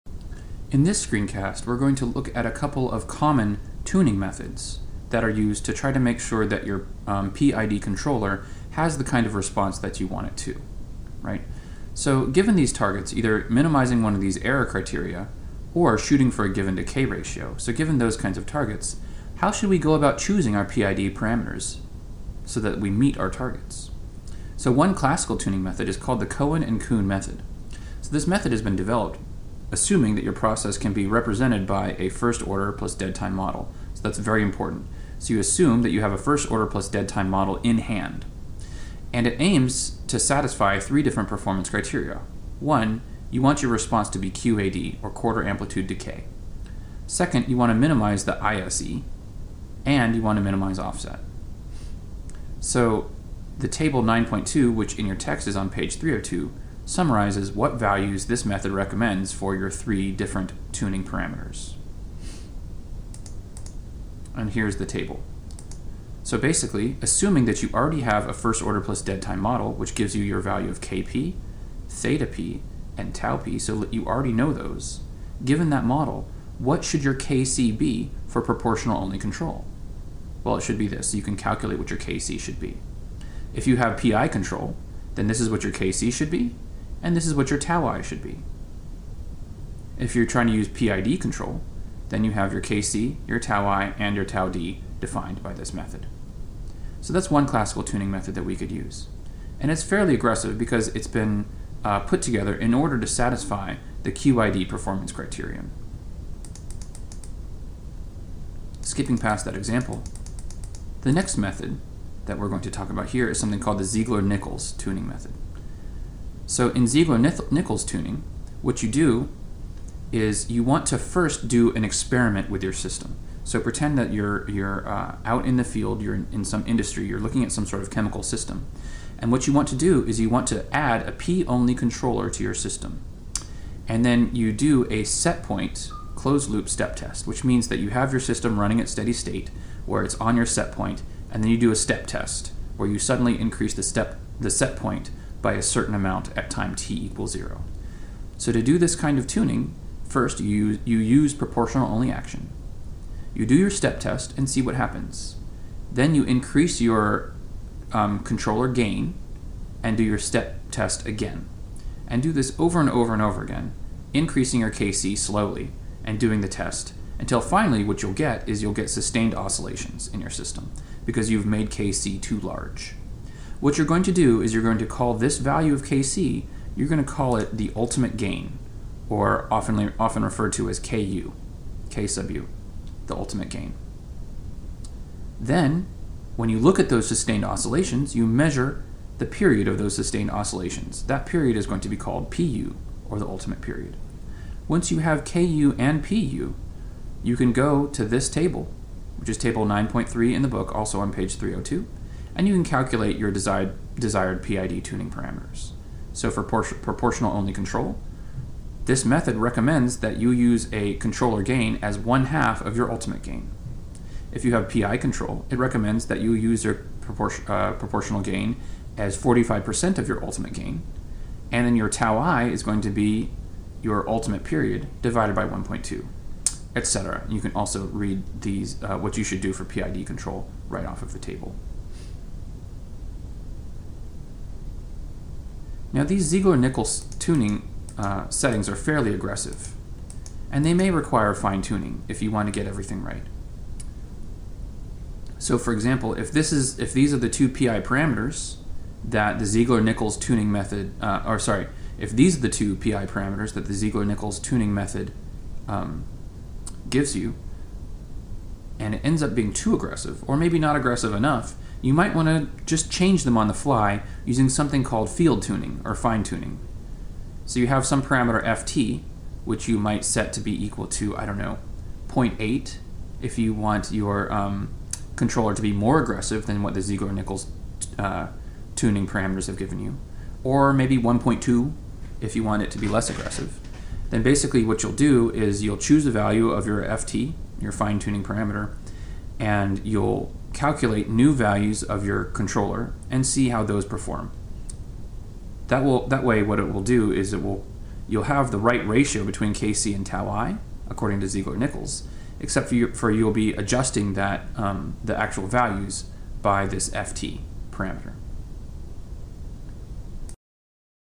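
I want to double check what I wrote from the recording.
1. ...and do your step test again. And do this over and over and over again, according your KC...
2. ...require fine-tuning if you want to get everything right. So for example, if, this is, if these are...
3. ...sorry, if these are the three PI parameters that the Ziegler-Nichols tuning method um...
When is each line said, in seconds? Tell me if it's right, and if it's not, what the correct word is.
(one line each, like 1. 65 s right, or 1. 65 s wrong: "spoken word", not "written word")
1. 159 s wrong: "increasing", not "according"
2. 240 s right
3. 251 s wrong: "two", not "three".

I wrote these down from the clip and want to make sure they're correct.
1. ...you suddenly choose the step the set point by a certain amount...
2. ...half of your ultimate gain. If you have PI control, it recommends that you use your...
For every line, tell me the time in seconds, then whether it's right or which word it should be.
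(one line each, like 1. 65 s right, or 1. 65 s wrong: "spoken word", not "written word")
1. 142 s wrong: "increase", not "choose"
2. 212 s right.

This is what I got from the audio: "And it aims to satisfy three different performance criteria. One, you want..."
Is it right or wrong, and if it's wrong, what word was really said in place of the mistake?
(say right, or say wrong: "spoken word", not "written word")
right.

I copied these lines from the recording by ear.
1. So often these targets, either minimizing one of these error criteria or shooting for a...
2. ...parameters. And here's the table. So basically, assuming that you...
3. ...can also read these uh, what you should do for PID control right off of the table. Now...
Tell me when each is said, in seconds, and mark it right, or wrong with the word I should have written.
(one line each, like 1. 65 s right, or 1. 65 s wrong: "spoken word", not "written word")
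1. 11 s wrong: "given", not "often"
2. 61 s right
3. 227 s right.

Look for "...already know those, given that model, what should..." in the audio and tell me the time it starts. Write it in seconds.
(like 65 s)
74 s.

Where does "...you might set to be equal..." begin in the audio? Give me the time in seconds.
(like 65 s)
269 s.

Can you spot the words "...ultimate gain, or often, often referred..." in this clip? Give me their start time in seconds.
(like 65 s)
177 s.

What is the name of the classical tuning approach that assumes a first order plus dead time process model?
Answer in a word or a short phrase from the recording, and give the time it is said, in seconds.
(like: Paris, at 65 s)
Cohen and Coon, at 26 s.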